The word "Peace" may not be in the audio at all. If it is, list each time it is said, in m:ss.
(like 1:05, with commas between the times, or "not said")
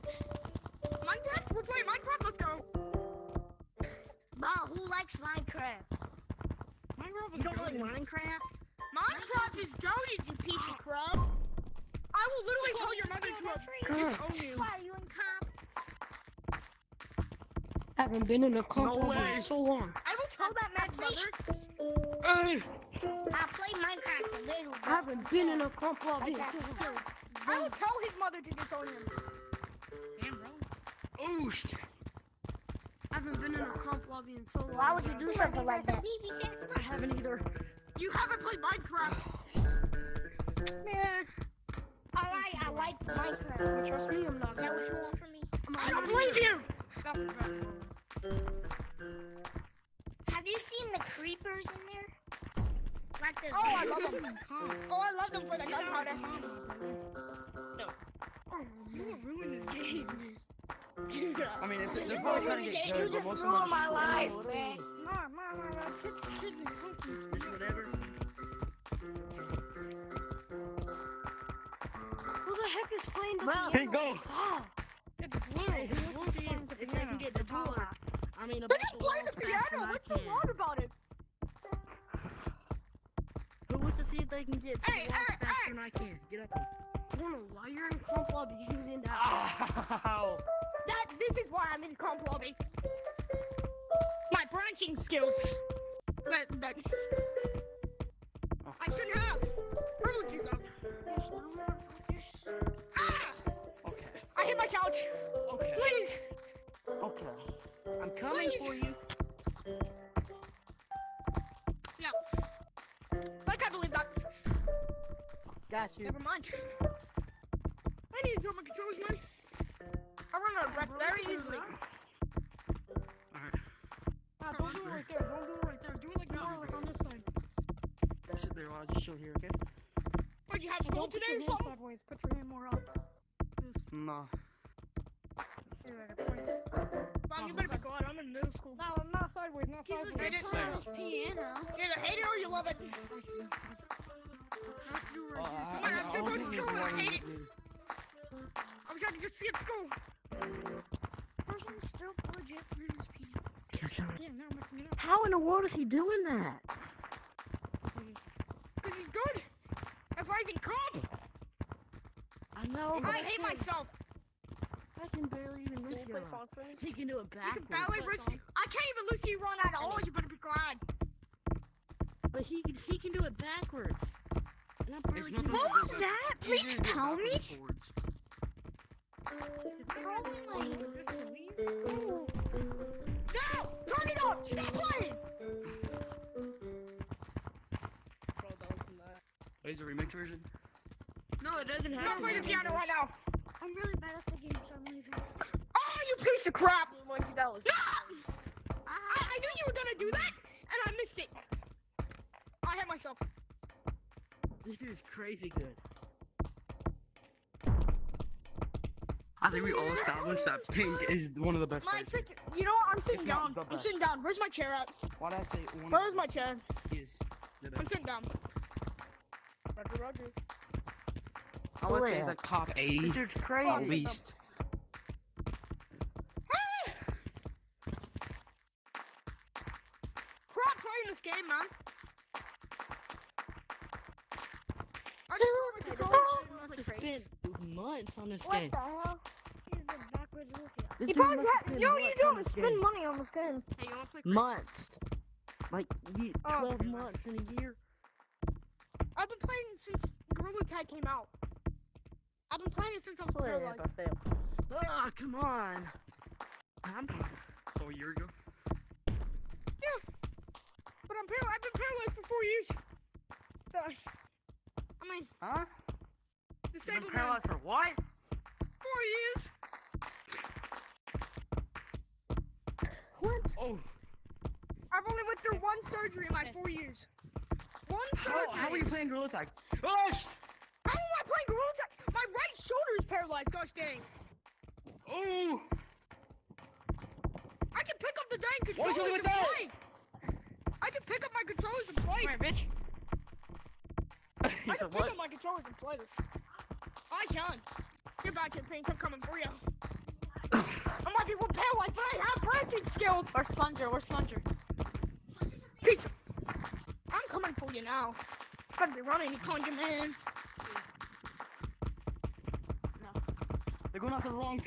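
5:05.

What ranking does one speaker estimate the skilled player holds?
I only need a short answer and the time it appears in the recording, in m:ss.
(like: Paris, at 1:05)
top 80, at 3:42.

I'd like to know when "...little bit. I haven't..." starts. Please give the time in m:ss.
0:24.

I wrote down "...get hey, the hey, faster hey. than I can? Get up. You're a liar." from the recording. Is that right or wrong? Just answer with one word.
right.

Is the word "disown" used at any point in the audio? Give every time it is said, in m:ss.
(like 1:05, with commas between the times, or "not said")
0:14, 0:28.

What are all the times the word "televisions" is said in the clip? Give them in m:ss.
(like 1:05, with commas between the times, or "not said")
not said.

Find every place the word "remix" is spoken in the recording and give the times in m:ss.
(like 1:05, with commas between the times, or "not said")
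3:09.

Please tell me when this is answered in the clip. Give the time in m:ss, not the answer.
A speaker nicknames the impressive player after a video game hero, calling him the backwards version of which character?
4:00.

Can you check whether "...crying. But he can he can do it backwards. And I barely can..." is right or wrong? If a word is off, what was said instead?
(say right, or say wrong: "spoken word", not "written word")
right.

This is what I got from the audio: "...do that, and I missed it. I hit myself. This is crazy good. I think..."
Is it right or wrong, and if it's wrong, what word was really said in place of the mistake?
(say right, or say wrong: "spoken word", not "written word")
right.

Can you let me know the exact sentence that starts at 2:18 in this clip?
No, I'm not sideways, not sideways.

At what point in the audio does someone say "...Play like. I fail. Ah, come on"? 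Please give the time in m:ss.
4:13.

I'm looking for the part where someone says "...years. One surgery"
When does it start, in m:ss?
4:36.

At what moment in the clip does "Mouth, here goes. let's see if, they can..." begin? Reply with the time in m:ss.
1:13.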